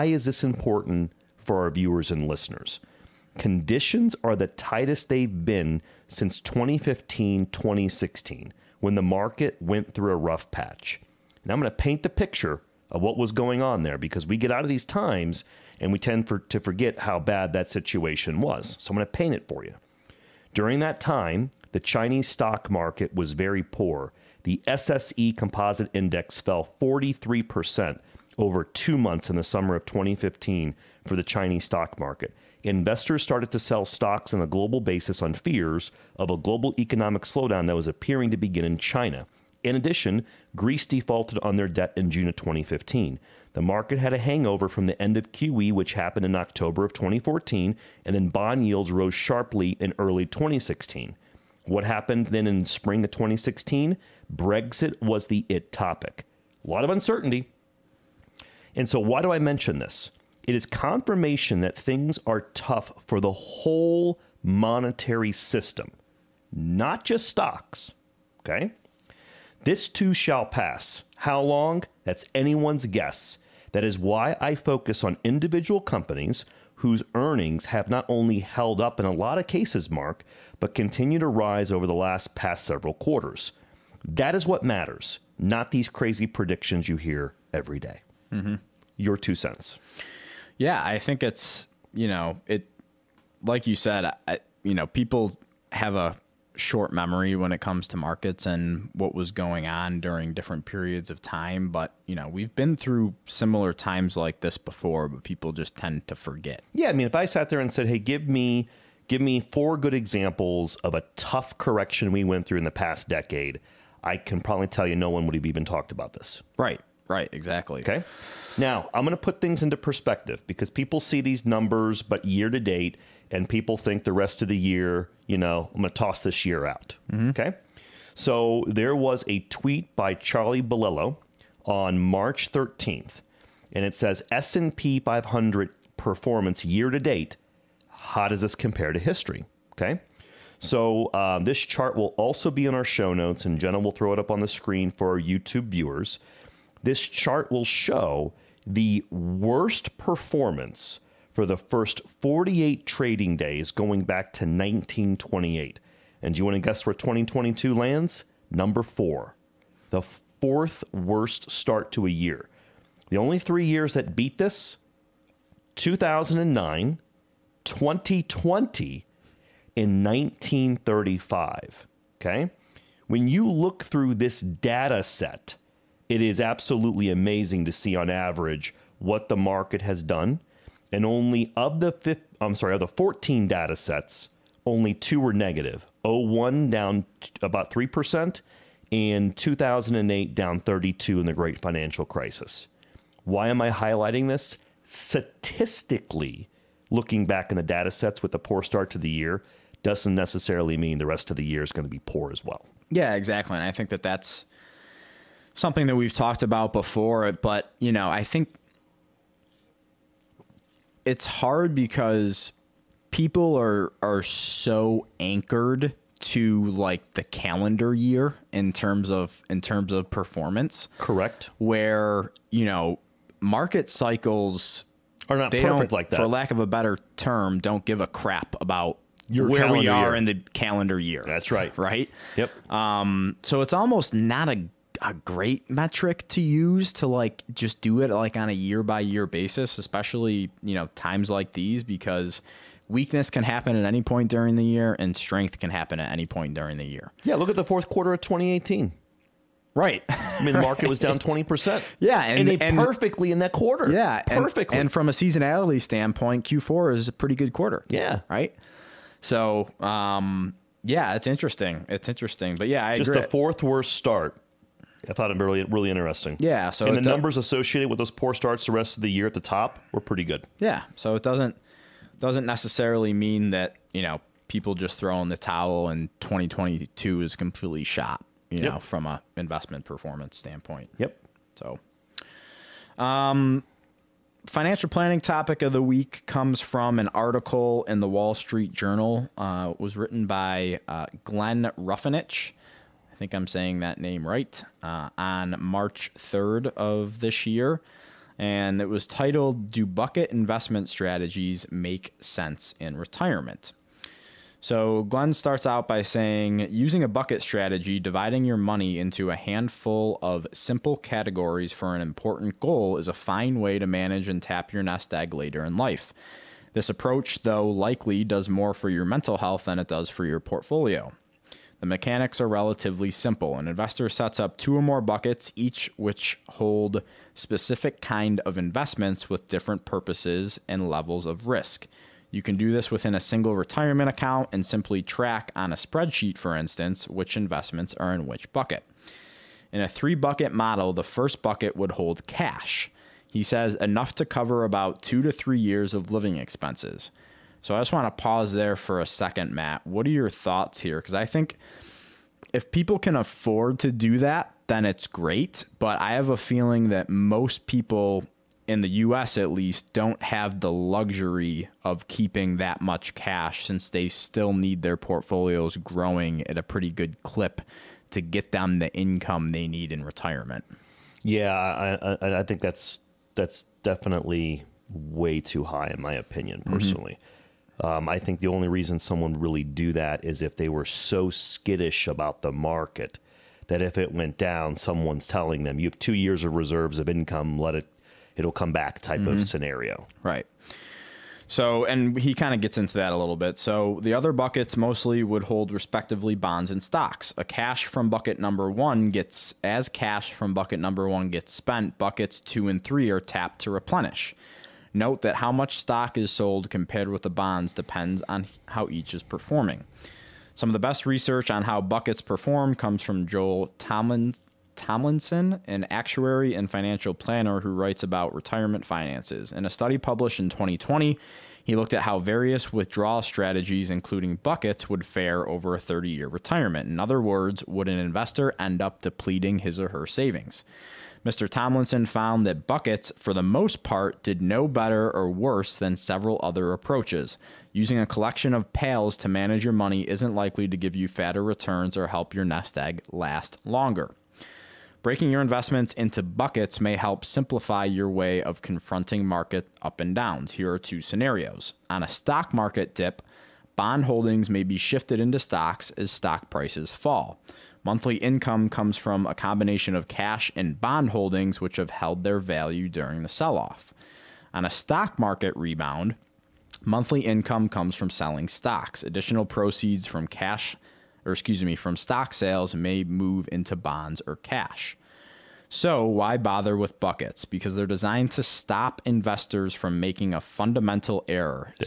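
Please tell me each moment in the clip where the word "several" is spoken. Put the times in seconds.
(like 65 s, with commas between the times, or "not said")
82 s, 435 s.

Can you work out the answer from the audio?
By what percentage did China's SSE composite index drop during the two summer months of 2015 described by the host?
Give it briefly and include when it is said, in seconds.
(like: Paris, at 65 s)
43%, at 26 s.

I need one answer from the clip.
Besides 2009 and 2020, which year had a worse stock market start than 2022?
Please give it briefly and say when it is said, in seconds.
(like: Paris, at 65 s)
1935, at 170 s.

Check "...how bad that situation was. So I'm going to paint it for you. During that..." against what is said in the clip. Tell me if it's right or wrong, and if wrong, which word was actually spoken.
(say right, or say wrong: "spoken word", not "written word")
right.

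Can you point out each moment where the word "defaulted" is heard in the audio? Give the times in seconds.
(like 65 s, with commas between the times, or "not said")
40 s.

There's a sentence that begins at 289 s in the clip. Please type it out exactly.
Uh, was written by uh, Glenn Ruffenach think I'm saying that name right, uh, on March 3rd of this year.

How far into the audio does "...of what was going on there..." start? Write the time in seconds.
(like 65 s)
12 s.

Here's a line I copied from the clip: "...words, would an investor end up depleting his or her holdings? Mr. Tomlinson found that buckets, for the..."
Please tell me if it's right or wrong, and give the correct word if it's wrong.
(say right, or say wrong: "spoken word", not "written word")
wrong: "savings", not "holdings".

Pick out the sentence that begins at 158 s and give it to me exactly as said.
Number four, the fourth worst start to a year.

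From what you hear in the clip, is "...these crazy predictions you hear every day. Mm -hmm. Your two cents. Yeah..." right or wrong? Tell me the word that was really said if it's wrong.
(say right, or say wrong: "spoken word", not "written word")
right.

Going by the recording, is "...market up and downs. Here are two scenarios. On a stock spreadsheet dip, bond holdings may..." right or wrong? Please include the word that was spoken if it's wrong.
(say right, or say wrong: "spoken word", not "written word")
wrong: "market", not "spreadsheet".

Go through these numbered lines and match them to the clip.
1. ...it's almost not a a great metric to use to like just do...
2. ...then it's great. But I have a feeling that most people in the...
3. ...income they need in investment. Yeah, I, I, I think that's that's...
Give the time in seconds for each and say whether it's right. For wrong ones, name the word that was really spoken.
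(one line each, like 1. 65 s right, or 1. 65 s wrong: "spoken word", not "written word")
1. 233 s right
2. 354 s right
3. 368 s wrong: "retirement", not "investment".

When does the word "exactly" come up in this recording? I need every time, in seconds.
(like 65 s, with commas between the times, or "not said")
117 s, 203 s.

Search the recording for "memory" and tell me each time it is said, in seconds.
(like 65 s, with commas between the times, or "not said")
96 s.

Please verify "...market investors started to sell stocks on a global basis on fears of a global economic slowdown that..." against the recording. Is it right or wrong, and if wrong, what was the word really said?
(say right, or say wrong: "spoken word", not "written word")
right.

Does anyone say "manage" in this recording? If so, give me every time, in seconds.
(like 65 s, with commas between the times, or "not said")
313 s, 439 s.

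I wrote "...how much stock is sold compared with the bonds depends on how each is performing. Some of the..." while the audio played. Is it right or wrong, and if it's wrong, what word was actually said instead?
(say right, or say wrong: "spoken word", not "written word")
right.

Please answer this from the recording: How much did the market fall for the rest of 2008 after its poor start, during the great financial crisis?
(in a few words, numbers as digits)
32%.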